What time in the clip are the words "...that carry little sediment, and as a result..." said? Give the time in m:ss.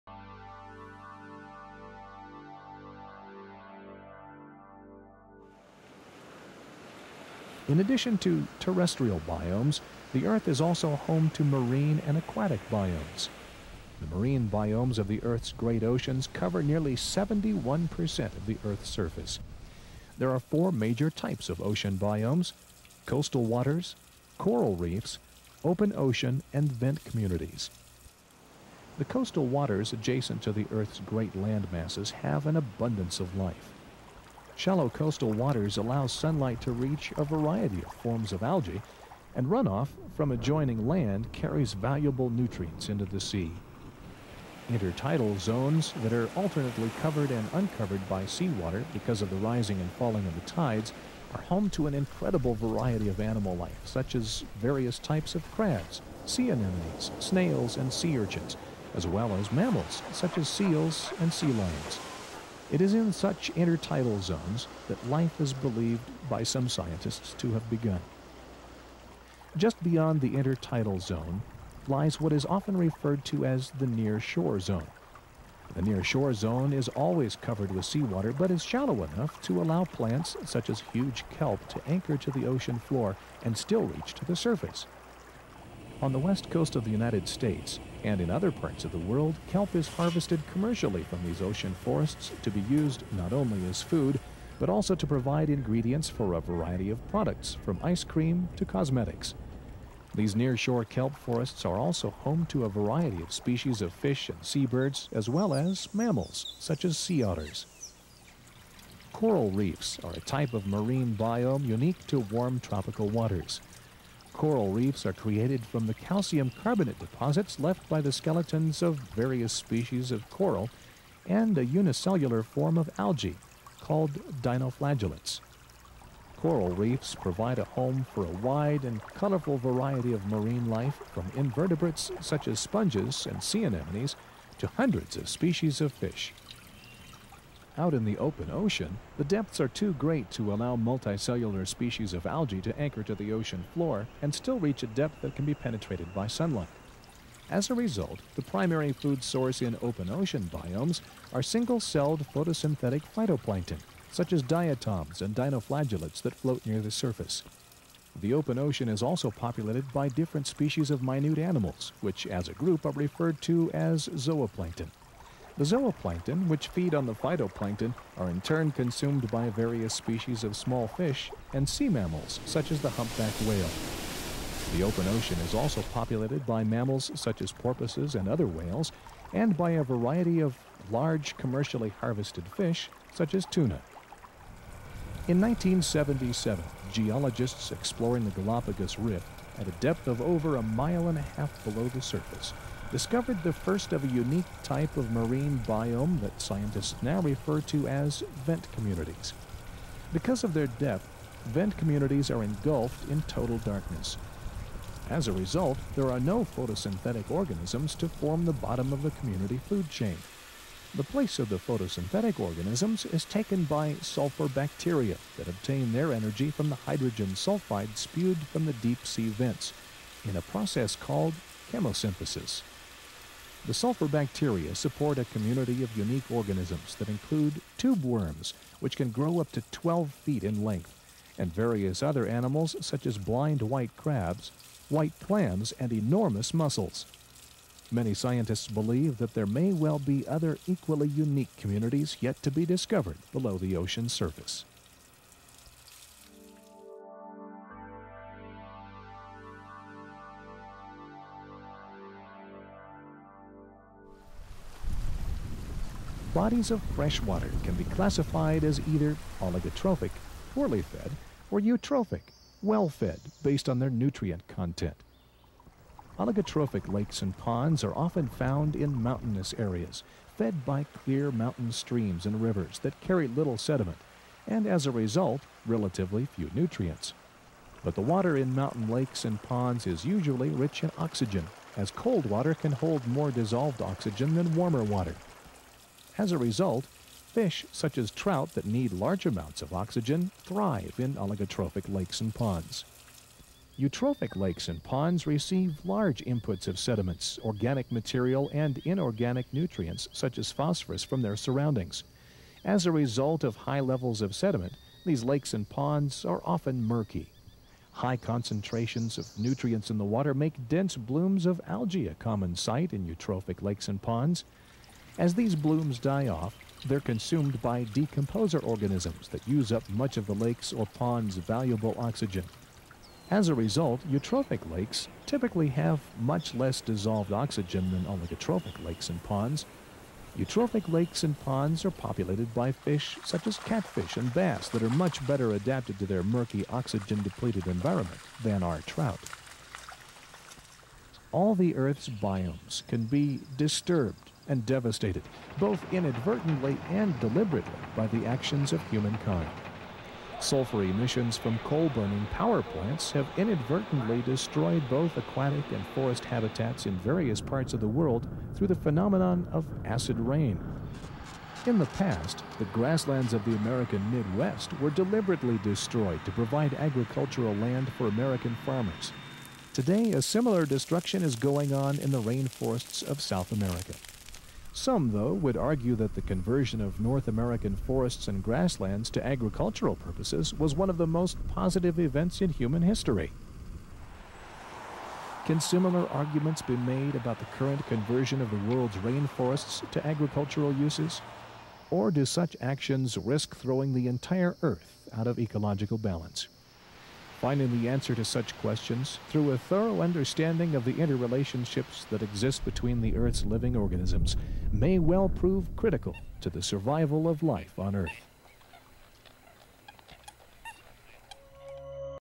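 4:32.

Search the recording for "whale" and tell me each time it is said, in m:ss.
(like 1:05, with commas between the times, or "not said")
2:53, 2:58.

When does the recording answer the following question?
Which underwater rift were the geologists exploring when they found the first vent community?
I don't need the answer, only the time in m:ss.
3:08.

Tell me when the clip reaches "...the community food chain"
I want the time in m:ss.
3:29.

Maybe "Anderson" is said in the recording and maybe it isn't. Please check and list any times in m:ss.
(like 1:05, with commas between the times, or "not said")
not said.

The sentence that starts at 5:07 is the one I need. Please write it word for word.
High concentrations of nutrients in the water make dense blooms of algae a common sight in eutrophic lakes and ponds.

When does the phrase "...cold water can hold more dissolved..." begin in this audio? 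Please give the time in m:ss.
4:41.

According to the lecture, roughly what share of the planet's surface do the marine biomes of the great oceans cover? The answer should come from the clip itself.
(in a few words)
71%.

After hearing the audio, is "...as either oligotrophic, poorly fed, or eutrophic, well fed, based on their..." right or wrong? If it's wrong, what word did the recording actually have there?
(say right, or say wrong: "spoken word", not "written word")
right.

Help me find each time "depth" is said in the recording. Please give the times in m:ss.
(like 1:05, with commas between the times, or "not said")
2:19, 2:24, 3:09, 3:20.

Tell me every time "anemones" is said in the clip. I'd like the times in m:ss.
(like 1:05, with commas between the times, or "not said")
0:56, 2:13.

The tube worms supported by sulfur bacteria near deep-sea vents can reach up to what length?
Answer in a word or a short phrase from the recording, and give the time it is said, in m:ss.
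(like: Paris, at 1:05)
12 feet, at 3:49.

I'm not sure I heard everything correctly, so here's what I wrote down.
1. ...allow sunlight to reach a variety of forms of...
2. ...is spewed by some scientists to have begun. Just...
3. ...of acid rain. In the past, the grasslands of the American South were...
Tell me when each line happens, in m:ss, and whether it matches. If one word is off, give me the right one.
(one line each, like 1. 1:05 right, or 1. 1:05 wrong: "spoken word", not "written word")
1. 0:35 right
2. 1:05 wrong: "believed", not "spewed"
3. 5:59 wrong: "Midwest", not "South".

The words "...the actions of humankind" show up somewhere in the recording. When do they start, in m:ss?
5:48.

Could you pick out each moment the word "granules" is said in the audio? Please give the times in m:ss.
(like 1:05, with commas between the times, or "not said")
not said.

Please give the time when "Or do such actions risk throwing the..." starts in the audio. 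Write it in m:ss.
6:31.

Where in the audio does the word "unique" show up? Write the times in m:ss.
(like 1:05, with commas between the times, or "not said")
1:51, 3:14, 3:45, 4:01.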